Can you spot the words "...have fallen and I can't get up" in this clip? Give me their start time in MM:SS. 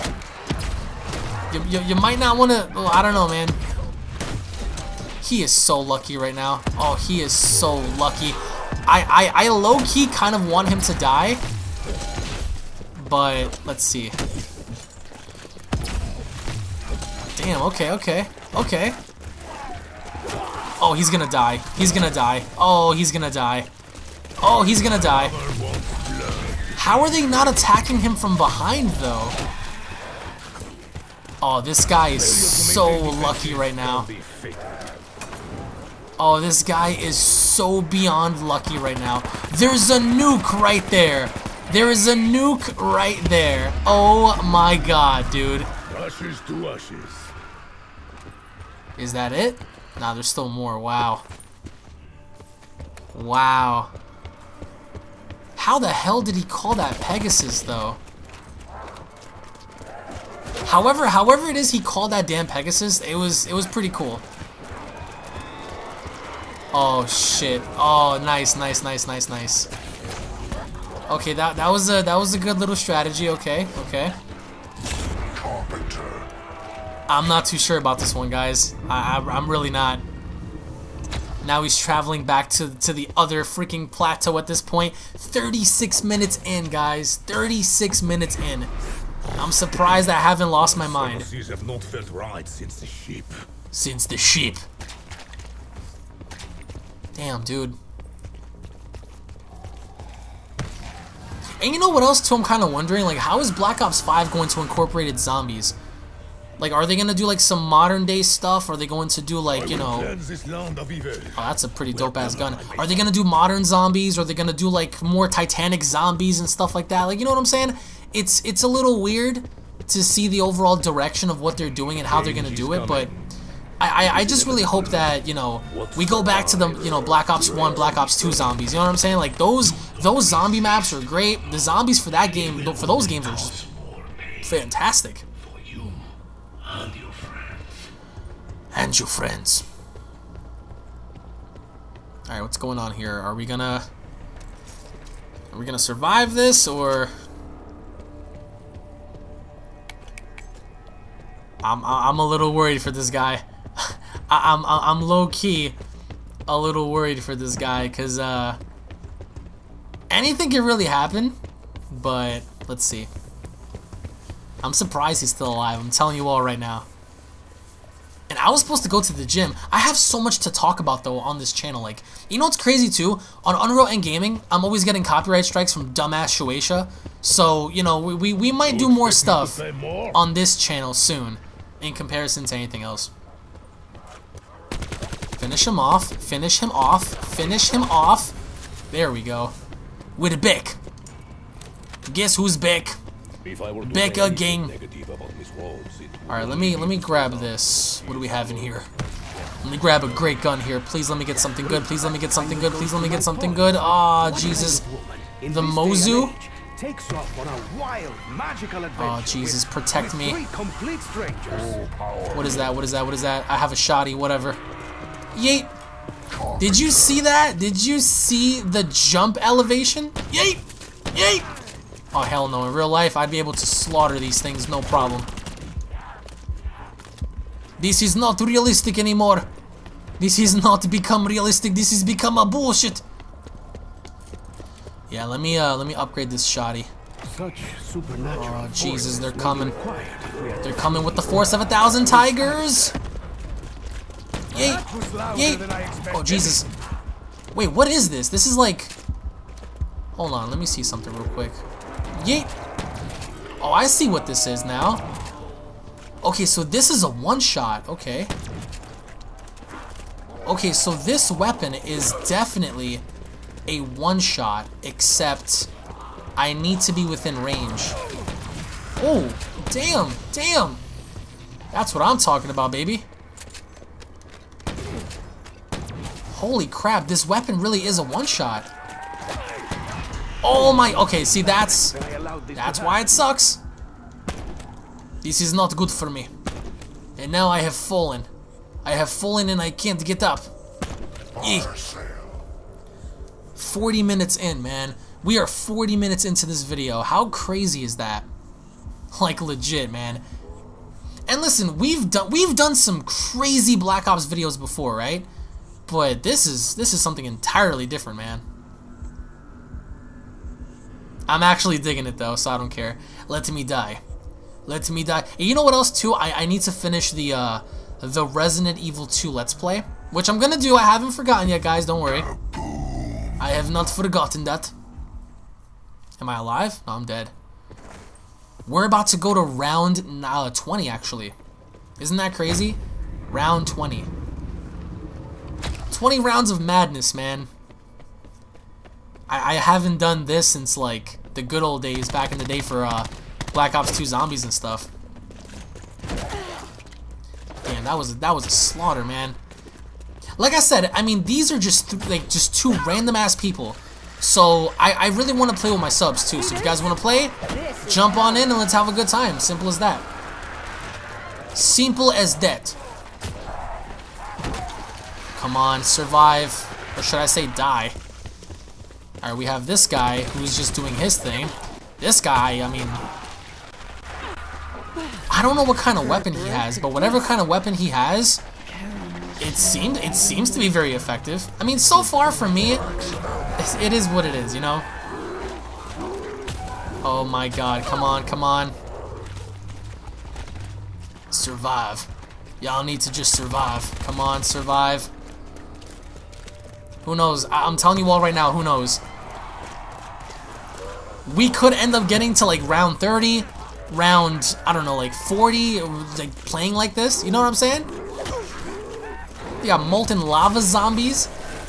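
04:48.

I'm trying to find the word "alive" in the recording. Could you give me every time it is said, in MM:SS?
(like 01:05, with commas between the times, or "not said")
02:45, 05:26.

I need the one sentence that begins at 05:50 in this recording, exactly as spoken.
Like I said, I mean, these are just, th like, just two random-ass people.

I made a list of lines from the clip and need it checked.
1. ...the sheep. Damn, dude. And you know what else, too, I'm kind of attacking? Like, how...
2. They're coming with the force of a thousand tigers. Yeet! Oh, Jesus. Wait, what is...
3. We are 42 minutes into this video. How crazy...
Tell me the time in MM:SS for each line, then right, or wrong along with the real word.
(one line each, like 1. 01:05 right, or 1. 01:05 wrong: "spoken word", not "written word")
1. 01:34 wrong: "wondering", not "attacking"
2. 04:00 right
3. 04:55 wrong: "40", not "42".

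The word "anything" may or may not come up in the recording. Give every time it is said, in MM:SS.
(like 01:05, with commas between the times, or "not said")
02:40, 03:02.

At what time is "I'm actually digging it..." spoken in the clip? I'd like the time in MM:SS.
05:11.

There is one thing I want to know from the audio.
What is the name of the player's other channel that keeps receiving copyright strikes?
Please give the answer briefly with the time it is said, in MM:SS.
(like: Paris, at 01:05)
UnrealEntGaming, at 02:53.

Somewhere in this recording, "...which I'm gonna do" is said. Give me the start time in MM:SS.
05:20.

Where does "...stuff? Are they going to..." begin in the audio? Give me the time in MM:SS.
01:48.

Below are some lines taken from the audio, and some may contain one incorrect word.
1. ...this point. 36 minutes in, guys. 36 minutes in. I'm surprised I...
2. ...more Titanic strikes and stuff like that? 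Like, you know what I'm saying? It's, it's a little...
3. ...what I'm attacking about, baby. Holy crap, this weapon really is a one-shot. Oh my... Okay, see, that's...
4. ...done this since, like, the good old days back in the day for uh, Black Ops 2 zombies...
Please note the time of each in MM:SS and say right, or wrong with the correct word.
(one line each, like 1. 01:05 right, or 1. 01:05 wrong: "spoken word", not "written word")
1. 01:24 right
2. 01:55 wrong: "zombies", not "strikes"
3. 04:31 wrong: "talking", not "attacking"
4. 05:39 right.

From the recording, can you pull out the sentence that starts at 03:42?
In real life, I'd be able to slaughter these things, no problem.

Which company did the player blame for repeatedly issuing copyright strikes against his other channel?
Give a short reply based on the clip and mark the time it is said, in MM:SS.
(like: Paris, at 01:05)
Shueisha, at 02:56.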